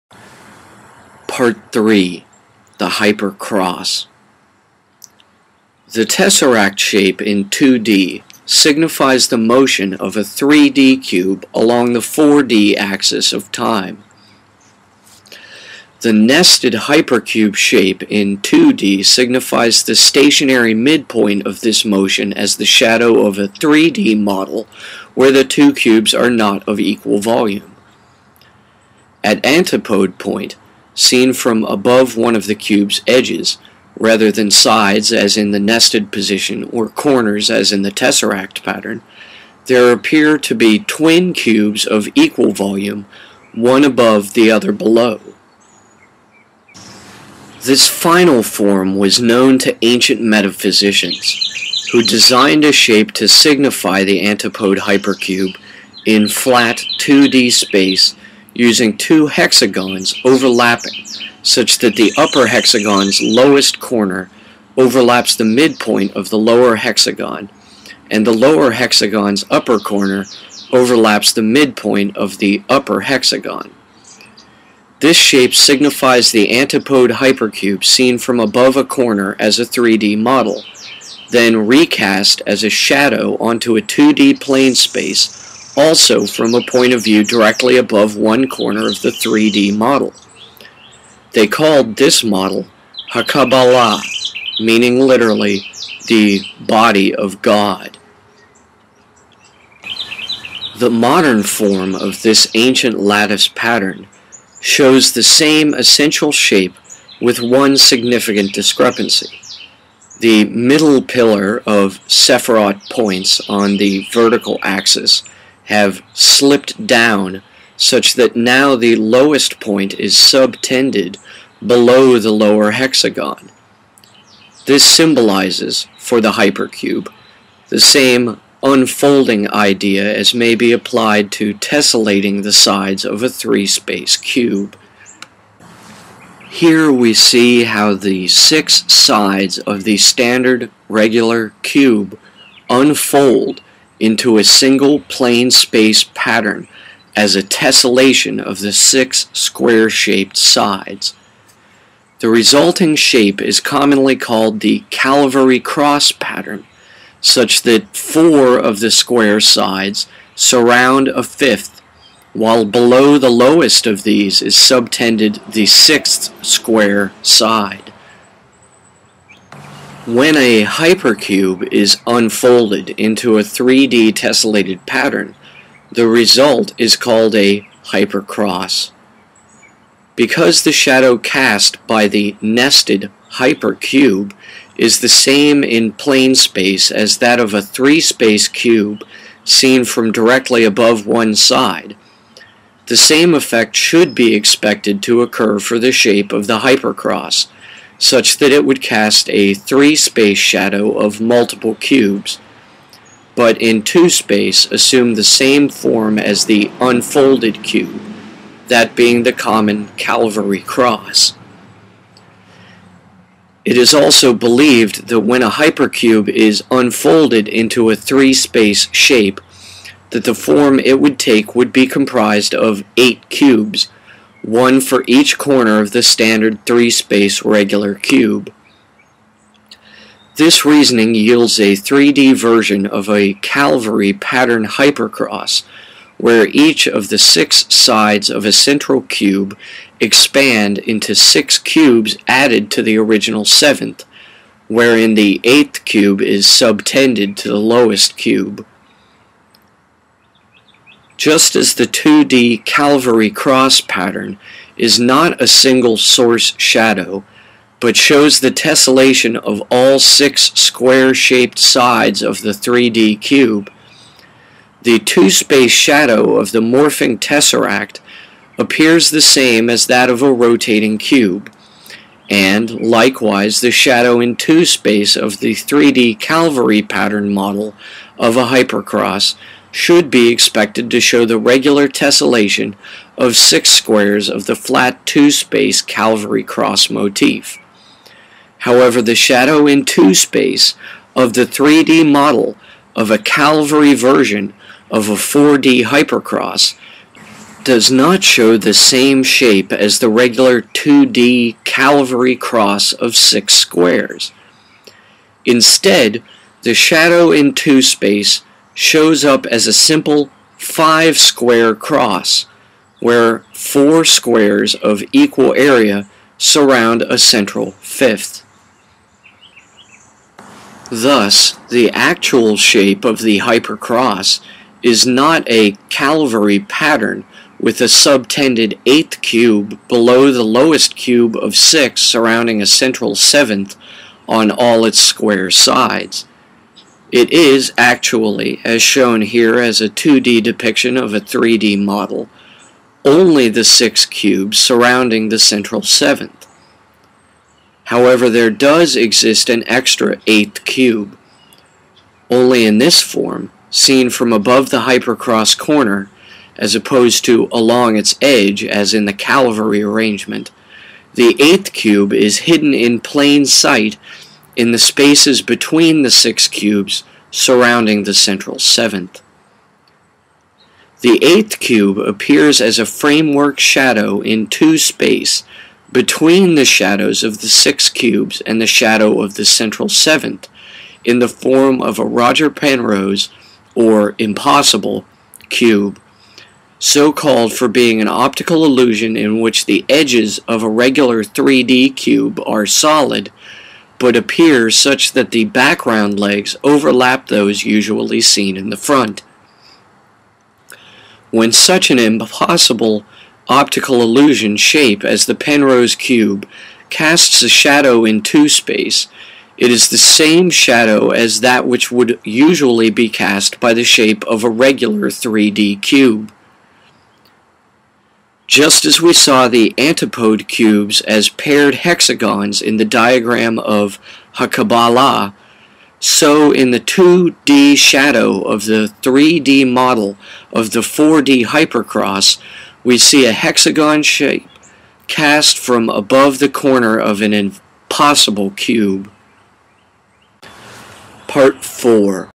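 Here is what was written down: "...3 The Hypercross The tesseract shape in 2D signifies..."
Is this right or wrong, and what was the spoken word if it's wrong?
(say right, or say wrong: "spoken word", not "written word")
right.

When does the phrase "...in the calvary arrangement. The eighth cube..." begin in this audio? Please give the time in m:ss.
5:58.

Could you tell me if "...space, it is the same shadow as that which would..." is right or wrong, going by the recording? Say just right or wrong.
right.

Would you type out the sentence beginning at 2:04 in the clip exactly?
This symbolizes, for the hypercube, the same unfolding idea as may be applied to tessellating the sides of a three-space cube.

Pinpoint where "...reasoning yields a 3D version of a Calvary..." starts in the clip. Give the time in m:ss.
3:50.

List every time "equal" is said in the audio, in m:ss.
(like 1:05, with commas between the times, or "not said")
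0:26, 0:42, 5:15.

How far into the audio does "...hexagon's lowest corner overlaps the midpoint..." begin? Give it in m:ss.
1:02.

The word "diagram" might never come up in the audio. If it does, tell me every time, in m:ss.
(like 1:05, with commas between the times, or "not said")
7:02.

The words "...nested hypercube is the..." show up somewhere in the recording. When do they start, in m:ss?
3:02.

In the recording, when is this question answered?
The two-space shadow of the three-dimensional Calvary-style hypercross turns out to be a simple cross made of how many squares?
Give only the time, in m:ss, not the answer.
5:10.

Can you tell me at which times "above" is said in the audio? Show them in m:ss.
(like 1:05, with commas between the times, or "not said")
0:31, 0:43, 1:18, 1:27, 3:10, 5:54, 7:15.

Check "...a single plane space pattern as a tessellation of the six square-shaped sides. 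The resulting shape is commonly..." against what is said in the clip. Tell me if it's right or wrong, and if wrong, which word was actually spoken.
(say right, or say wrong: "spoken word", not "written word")
right.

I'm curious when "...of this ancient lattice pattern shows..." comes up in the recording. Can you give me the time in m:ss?
1:41.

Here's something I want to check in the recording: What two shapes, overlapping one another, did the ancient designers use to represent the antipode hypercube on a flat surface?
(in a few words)
two hexagons.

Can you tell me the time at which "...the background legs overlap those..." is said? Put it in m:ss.
6:35.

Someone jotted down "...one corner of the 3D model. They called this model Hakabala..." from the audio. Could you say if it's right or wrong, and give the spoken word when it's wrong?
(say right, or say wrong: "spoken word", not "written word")
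right.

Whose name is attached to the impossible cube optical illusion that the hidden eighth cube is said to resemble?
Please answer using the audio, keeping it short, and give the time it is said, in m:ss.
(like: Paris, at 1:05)
Roger Penrose, at 6:22.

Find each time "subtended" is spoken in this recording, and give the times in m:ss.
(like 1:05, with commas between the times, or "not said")
2:00, 2:44, 4:06, 5:27.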